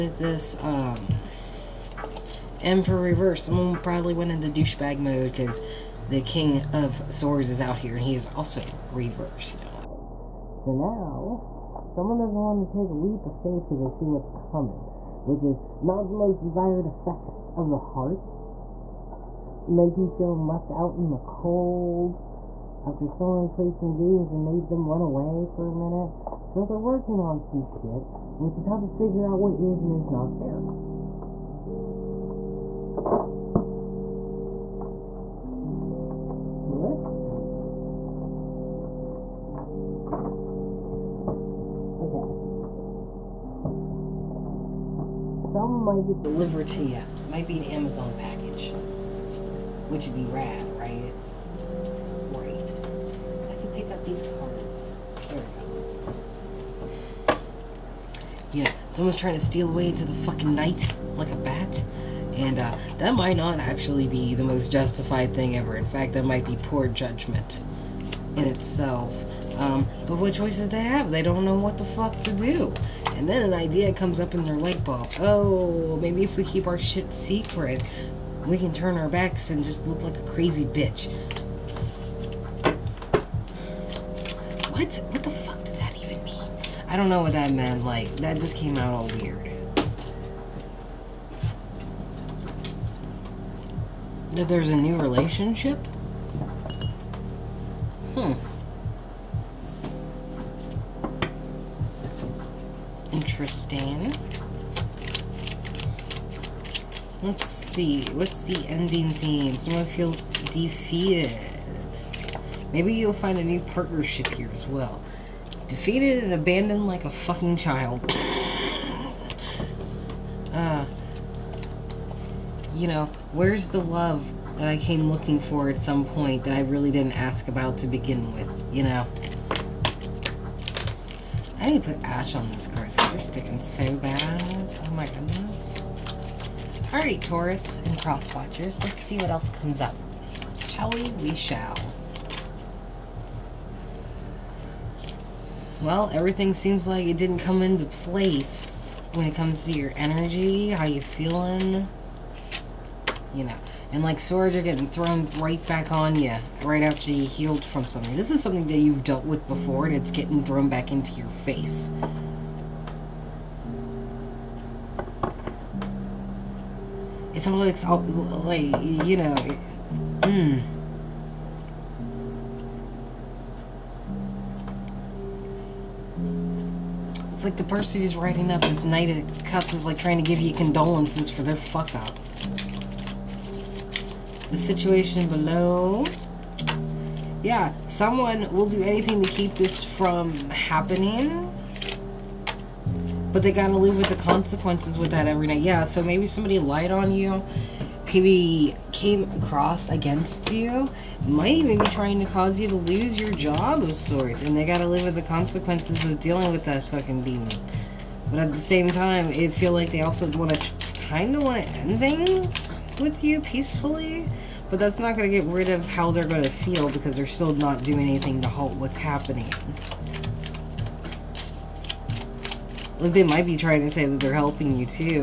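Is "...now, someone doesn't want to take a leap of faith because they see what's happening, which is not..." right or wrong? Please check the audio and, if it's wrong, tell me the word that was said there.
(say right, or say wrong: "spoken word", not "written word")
wrong: "coming", not "happening".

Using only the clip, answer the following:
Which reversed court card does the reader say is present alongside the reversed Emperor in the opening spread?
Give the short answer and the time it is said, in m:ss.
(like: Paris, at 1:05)
King of Swords, at 0:06.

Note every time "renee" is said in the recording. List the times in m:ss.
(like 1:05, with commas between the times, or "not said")
not said.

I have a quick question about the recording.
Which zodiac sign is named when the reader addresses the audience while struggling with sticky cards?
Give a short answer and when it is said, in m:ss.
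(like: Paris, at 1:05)
Taurus, at 2:17.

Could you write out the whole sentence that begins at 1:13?
And then an idea comes up in their light bulb.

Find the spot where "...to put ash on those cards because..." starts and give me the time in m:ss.
2:11.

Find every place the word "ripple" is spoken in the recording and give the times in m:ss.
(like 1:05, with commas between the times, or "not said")
not said.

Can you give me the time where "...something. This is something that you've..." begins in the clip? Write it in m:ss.
2:37.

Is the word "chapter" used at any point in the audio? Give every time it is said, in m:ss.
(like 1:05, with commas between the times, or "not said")
not said.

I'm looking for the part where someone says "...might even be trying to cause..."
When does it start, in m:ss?
3:21.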